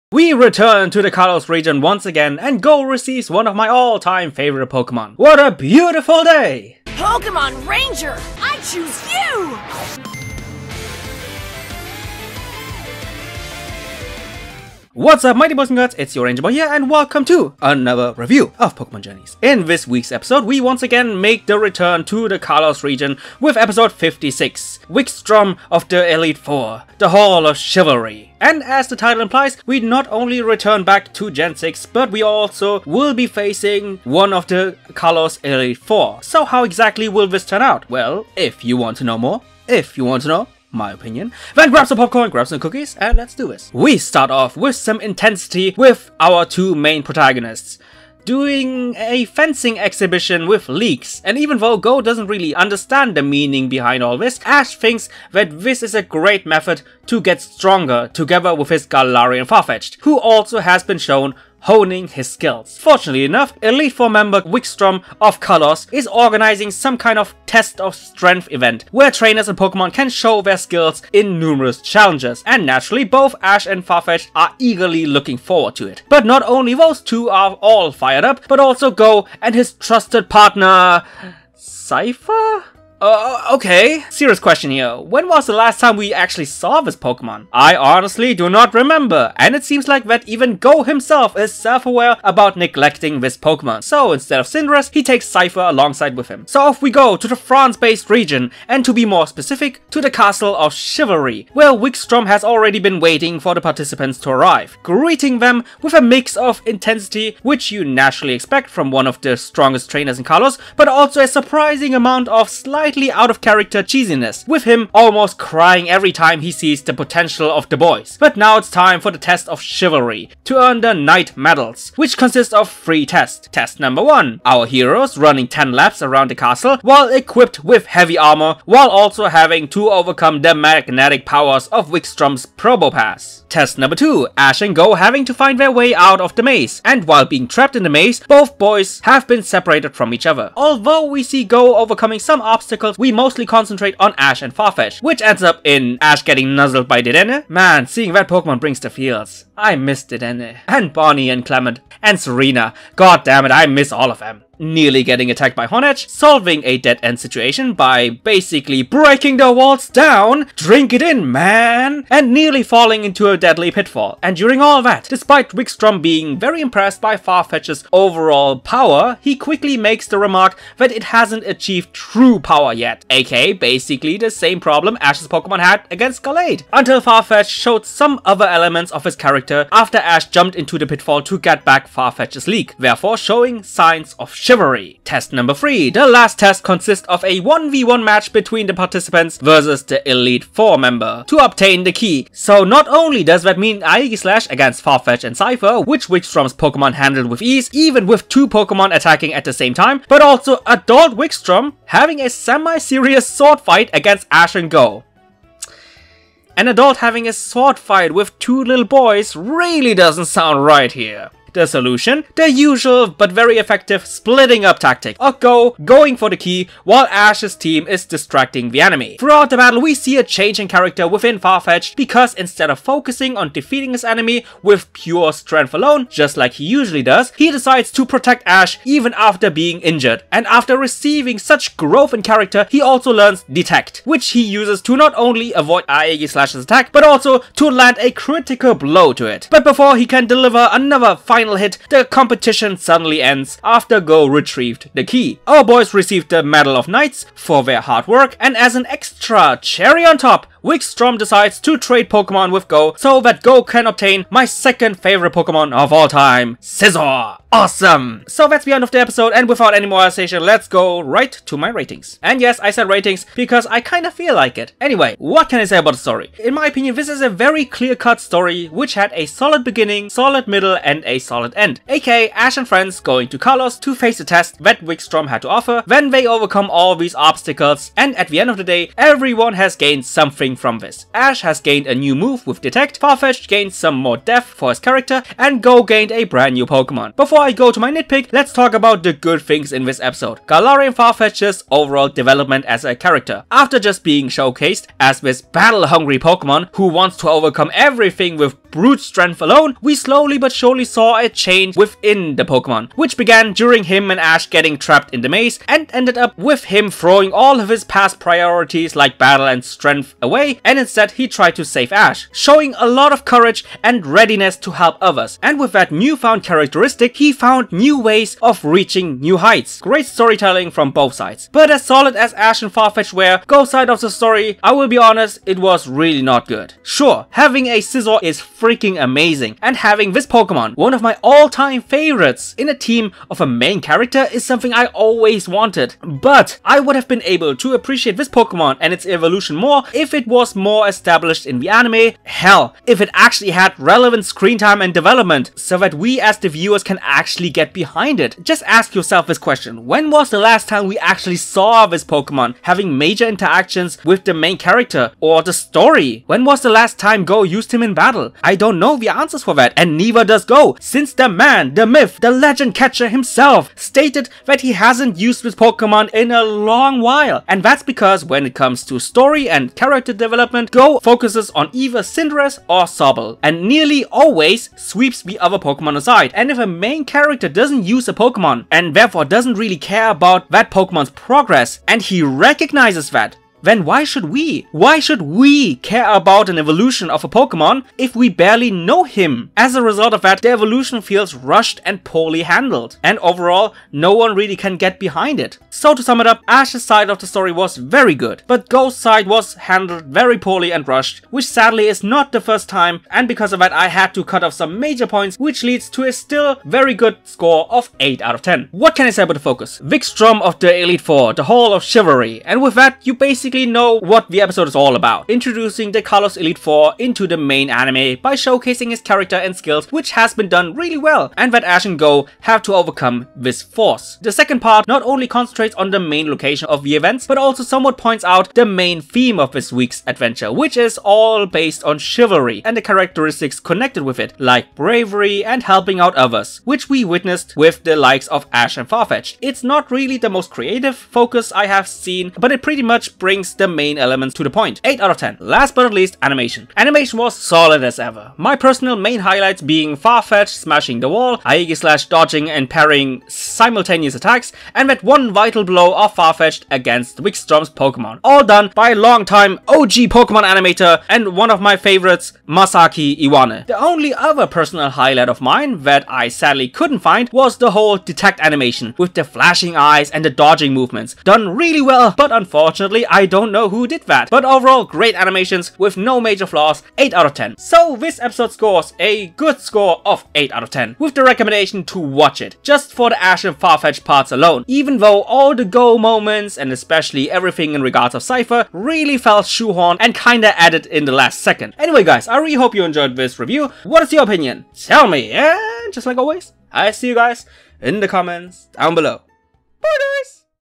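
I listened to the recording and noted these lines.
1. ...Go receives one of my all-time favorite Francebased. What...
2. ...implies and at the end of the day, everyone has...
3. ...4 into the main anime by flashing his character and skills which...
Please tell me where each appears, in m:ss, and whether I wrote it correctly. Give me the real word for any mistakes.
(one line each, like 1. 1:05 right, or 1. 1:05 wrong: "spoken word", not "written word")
1. 0:02 wrong: "Pokemon", not "Francebased"
2. 4:37 wrong: "obstacles", not "implies"
3. 6:56 wrong: "showcasing", not "flashing".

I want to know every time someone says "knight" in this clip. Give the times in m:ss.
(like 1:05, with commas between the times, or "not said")
2:00, 4:06.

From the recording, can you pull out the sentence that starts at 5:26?
Sure, having a Scizor is freaking amazing.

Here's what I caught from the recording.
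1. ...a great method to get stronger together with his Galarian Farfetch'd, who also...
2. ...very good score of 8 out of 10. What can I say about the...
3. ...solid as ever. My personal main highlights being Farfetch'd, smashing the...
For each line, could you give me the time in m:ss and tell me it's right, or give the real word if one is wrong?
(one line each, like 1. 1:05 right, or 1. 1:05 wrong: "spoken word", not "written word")
1. 0:55 right
2. 6:46 right
3. 7:27 right.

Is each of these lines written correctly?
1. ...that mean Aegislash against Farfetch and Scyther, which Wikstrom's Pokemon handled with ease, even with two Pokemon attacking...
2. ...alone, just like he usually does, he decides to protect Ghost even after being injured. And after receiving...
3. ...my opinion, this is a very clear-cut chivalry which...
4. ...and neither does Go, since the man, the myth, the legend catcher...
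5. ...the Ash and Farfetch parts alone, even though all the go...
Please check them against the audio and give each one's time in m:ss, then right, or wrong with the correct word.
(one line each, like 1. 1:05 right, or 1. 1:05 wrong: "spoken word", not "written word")
1. 3:13 right
2. 3:45 wrong: "Ash", not "Ghost"
3. 4:26 wrong: "story", not "chivalry"
4. 5:59 right
5. 8:03 right.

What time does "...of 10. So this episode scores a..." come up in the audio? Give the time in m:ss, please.
7:57.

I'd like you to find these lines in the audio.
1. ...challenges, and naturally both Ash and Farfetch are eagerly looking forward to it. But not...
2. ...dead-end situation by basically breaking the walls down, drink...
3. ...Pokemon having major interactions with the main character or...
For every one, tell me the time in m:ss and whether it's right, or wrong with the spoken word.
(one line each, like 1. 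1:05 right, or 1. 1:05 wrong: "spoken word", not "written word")
1. 1:11 right
2. 2:36 right
3. 5:52 right.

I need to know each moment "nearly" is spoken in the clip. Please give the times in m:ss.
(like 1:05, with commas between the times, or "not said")
2:34, 2:42, 6:13.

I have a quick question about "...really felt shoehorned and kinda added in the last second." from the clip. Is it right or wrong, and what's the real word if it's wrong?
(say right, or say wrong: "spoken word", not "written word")
right.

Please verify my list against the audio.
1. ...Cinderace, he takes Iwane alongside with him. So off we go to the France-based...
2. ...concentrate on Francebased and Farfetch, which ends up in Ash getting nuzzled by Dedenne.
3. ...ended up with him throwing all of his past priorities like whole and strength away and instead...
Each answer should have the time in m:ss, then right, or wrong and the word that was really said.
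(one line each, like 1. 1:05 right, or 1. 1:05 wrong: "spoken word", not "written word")
1. 1:34 wrong: "Scyther", not "Iwane"
2. 2:23 wrong: "Ash", not "Francebased"
3. 5:05 wrong: "battle", not "whole".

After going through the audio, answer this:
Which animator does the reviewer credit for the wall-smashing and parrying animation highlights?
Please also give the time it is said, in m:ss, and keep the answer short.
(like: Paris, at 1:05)
Masaki Iwane, at 7:42.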